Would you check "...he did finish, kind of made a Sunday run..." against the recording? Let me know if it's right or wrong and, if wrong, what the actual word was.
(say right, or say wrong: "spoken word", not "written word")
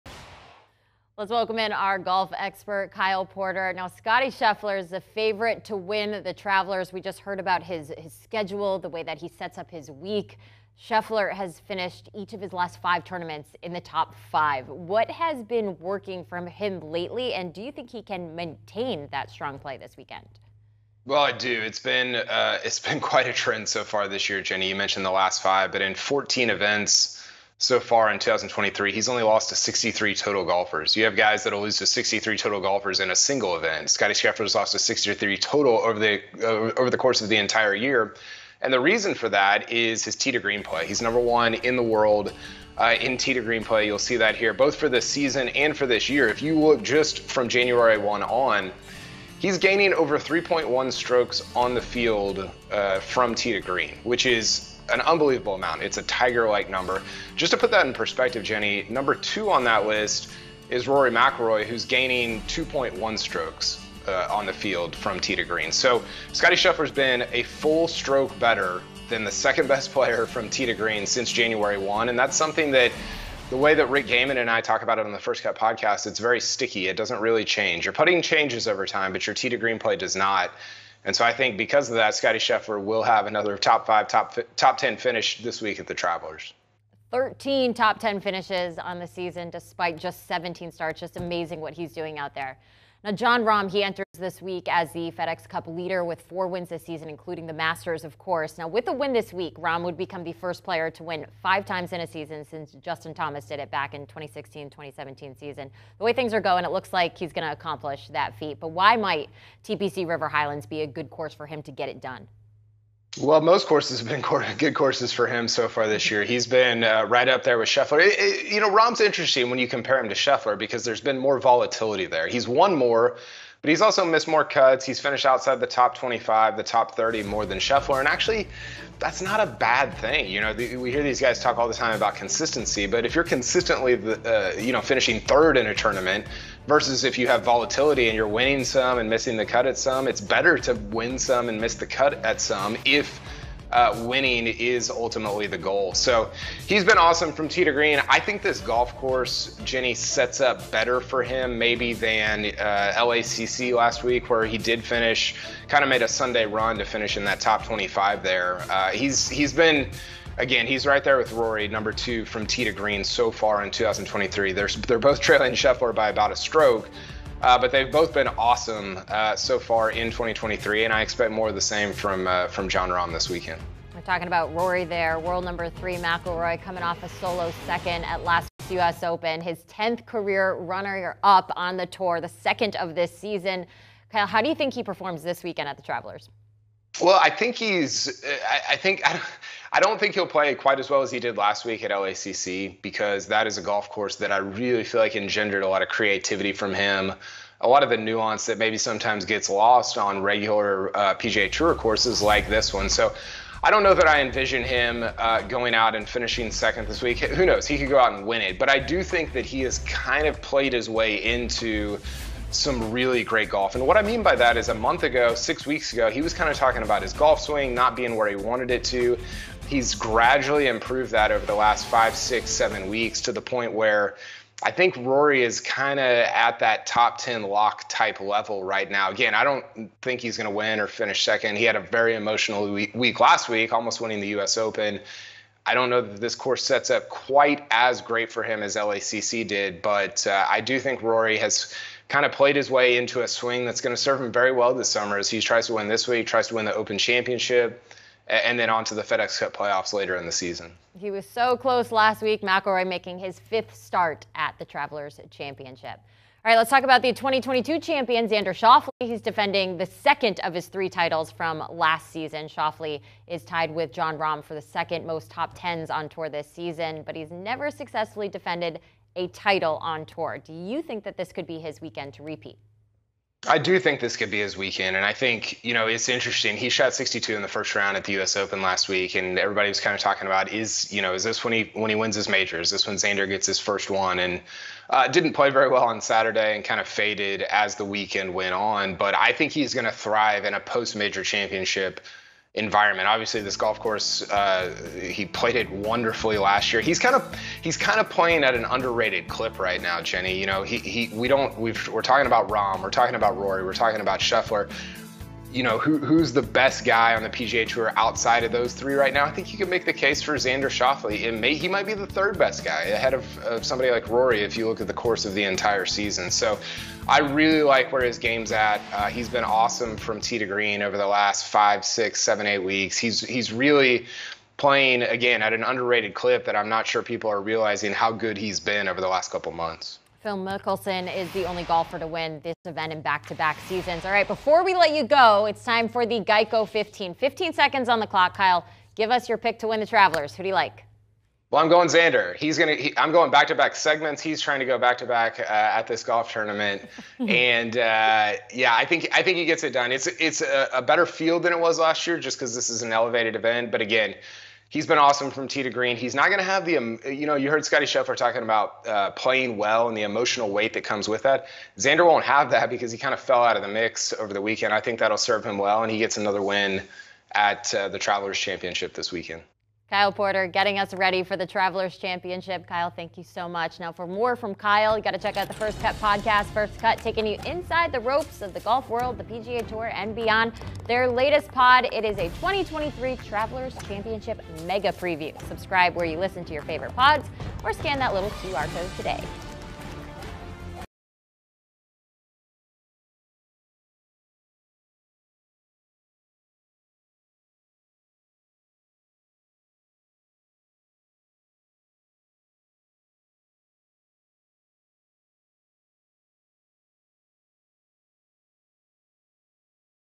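right.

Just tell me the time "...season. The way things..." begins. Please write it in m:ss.
1:45.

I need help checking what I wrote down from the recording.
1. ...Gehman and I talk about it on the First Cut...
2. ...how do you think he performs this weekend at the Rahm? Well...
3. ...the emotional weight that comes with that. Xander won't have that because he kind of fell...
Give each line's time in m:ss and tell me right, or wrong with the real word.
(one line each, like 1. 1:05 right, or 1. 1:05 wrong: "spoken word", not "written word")
1. 1:14 right
2. 3:04 wrong: "Travelers", not "Rahm"
3. 5:59 right.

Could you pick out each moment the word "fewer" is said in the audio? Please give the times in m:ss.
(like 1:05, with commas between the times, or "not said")
not said.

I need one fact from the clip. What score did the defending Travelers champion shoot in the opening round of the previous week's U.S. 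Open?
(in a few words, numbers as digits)
62.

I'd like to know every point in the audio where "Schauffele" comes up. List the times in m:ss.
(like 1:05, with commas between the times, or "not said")
4:18, 4:22, 5:10.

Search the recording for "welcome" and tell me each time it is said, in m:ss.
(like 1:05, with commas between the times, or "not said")
0:01.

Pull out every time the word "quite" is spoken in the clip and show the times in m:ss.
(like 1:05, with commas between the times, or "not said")
0:22, 3:10, 3:57.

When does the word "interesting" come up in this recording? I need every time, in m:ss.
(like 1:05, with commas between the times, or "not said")
1:59, 4:36.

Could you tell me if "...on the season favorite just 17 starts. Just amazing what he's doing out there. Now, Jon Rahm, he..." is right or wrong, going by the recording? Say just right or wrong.
wrong.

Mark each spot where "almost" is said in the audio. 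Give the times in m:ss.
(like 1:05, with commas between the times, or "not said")
3:53.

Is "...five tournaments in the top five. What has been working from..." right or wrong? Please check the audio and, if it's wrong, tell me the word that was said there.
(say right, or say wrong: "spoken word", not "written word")
right.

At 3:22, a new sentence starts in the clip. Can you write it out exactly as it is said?
So I don't know that I envision him uh, going out and finishing second this week.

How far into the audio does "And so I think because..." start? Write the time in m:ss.
1:21.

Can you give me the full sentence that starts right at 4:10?
He was so close last week, McIlroy making his fifth start at the Travelers Championship.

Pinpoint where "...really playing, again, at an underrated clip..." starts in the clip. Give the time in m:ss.
5:23.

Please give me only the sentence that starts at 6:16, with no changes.
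First Cut taking you inside the ropes of the golf world, the PGA Tour, and beyond.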